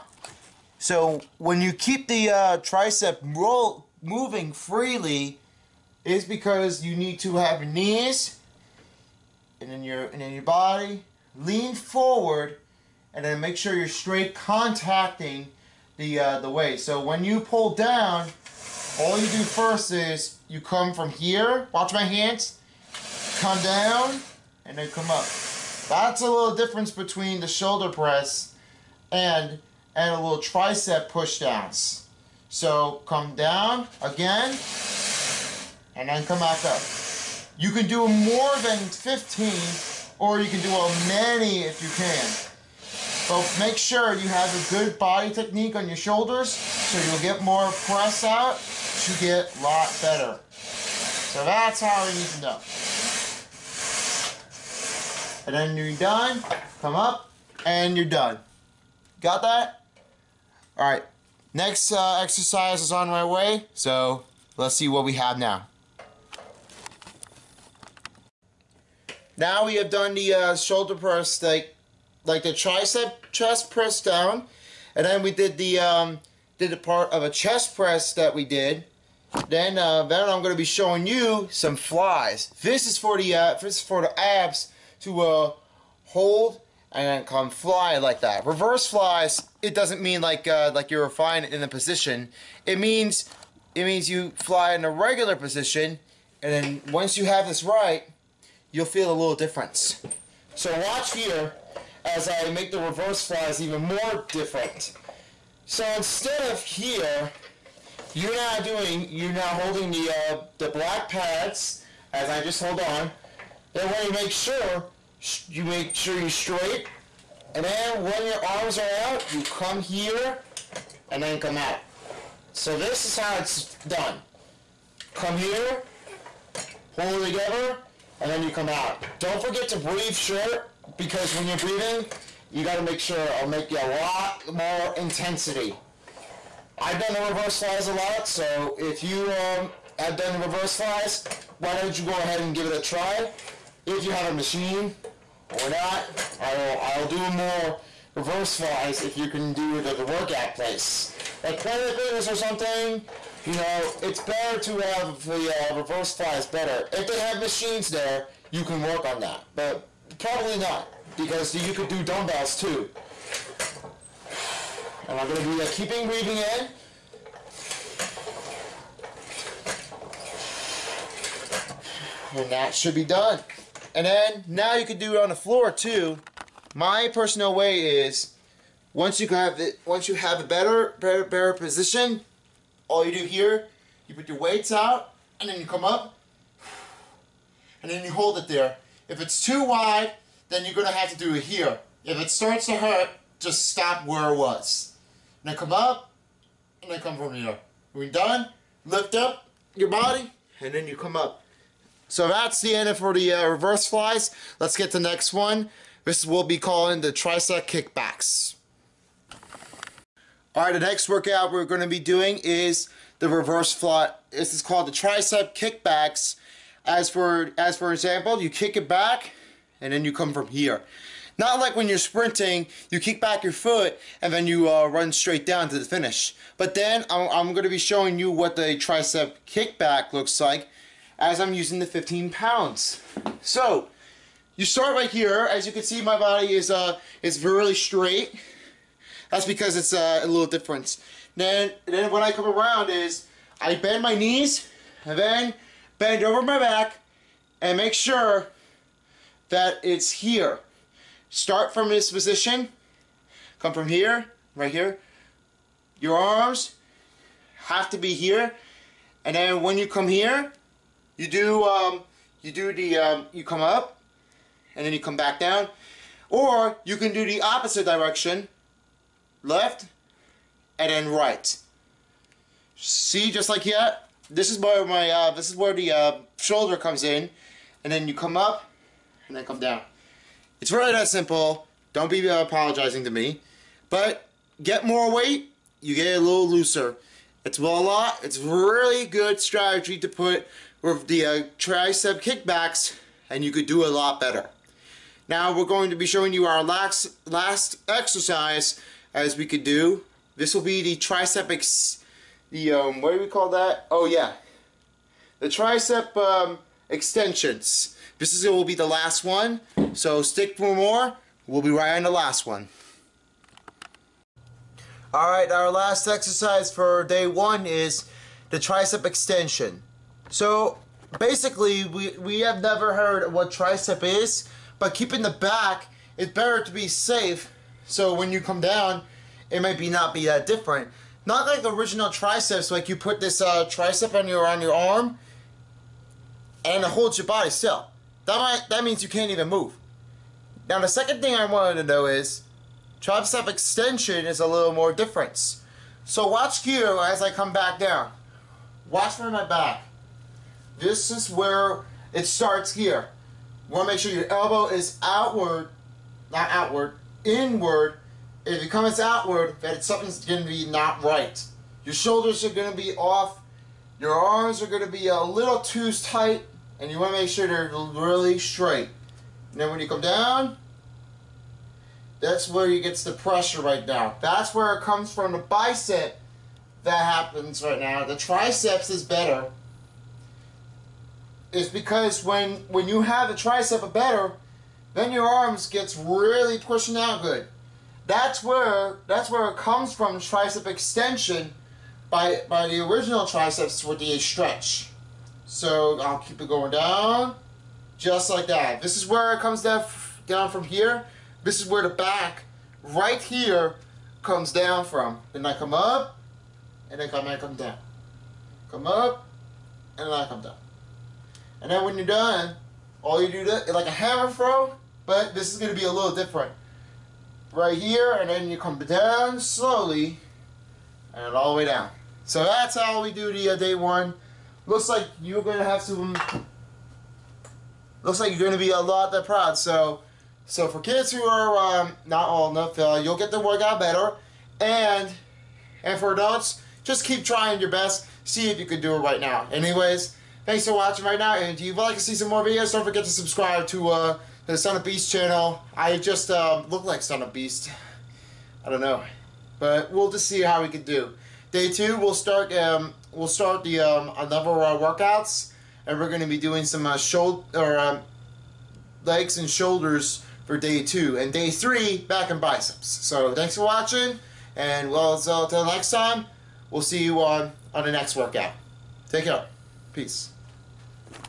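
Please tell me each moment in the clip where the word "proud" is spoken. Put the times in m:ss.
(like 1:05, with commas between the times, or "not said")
7:09.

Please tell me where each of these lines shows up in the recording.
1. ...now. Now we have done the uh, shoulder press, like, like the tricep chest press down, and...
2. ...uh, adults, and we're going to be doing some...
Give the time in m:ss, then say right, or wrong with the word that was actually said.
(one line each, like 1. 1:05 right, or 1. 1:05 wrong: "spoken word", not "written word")
1. 1:05 right
2. 7:34 wrong: "workouts", not "adults".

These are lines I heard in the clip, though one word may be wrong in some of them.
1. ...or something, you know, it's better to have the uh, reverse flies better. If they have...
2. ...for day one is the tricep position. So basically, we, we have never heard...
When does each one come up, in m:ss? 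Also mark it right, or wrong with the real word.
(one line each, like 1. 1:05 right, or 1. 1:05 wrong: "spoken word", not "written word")
1. 2:32 right
2. 5:16 wrong: "extension", not "position".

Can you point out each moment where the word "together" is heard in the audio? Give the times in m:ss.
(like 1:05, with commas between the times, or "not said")
2:07.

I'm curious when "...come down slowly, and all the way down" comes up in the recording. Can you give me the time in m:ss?
6:58.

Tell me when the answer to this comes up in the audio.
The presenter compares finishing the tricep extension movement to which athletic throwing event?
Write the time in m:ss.
6:53.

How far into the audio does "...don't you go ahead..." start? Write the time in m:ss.
2:21.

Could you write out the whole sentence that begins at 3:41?
Not like when you're sprinting, you kick back your foot and then you uh, run straight down to the finish.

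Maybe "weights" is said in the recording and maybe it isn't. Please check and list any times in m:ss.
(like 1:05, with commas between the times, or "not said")
3:04, 4:45.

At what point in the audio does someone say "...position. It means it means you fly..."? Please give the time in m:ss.
1:31.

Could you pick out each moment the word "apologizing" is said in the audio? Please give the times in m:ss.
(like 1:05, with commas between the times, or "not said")
4:42.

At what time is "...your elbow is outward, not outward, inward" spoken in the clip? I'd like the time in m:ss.
5:54.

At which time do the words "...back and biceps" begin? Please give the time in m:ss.
7:41.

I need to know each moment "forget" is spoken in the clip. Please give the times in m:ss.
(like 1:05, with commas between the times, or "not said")
2:09, 7:22.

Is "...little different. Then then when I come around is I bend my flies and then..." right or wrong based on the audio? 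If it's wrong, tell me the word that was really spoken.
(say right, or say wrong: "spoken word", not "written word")
wrong: "knees", not "flies".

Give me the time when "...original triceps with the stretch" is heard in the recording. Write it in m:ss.
6:32.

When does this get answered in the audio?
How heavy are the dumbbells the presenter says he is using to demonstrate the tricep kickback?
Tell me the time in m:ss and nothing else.
3:51.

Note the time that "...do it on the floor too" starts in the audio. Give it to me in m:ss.
2:54.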